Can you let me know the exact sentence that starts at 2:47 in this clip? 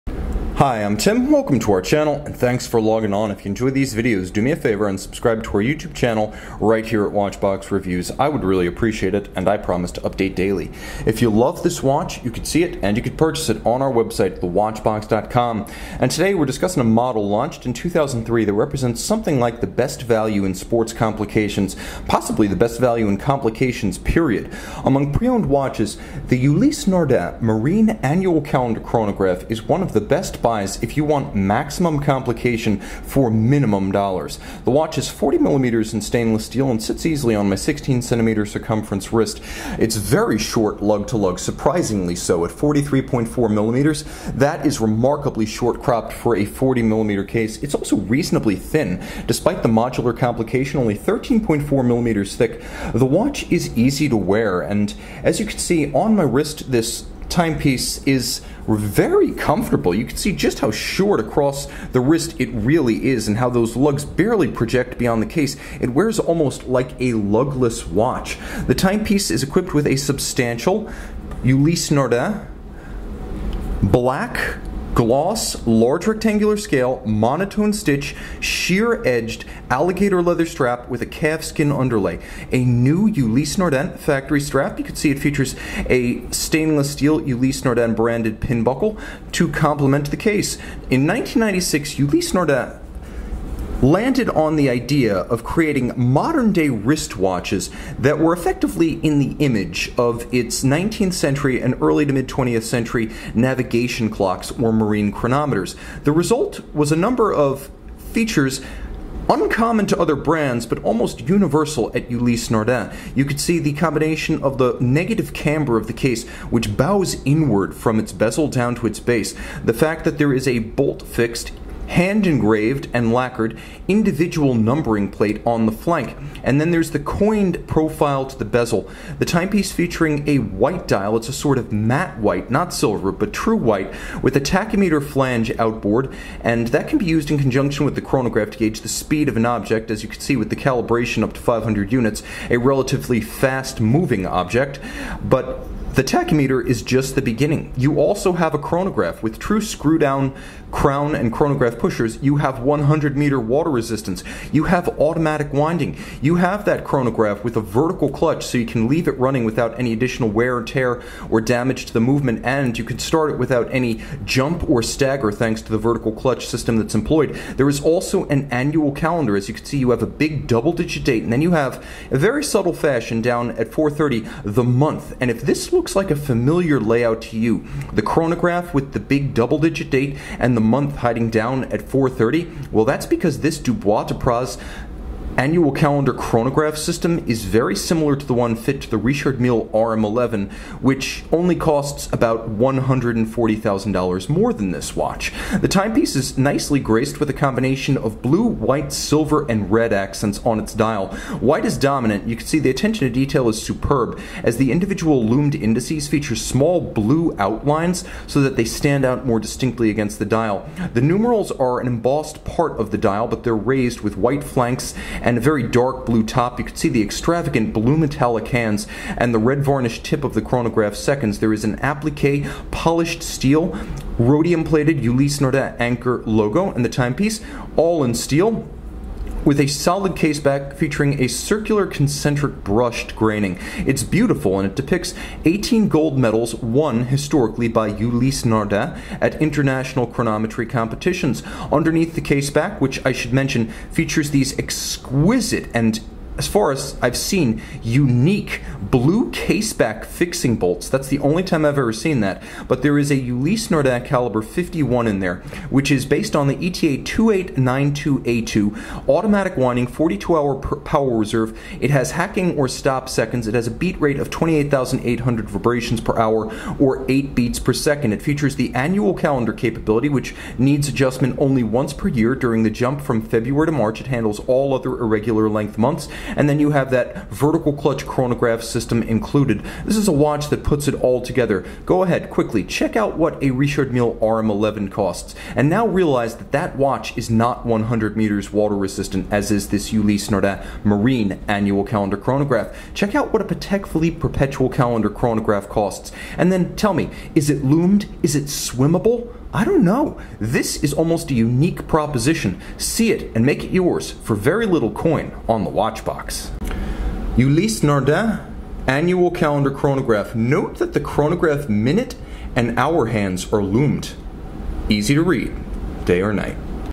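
There is also an annual calendar.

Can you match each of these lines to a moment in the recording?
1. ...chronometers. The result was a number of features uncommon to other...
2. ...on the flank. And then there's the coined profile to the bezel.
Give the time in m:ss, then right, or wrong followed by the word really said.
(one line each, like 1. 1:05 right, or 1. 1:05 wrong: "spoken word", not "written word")
1. 1:45 right
2. 2:05 right.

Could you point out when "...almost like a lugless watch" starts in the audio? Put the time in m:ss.
1:06.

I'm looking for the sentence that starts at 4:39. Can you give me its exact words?
This is a watch that puts it all together.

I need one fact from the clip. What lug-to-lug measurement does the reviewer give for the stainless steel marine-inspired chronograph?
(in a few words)
43.4 millimeters.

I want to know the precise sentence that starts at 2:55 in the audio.
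And if this looks looks like a familiar layout to you.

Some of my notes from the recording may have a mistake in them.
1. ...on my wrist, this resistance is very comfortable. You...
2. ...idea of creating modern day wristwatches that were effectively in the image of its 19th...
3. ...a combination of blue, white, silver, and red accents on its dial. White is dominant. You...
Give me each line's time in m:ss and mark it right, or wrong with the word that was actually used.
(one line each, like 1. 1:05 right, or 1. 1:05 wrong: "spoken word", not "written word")
1. 0:55 wrong: "timepiece", not "resistance"
2. 1:34 right
3. 3:17 right.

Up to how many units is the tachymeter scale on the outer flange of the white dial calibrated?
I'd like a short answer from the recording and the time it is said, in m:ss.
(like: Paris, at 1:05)
500, at 2:21.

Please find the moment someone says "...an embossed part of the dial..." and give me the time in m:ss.
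3:31.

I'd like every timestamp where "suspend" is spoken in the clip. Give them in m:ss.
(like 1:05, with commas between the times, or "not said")
not said.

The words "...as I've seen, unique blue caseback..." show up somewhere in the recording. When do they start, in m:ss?
4:06.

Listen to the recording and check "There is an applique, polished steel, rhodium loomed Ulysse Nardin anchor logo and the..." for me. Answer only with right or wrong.
wrong.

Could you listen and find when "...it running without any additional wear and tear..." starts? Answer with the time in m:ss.
2:39.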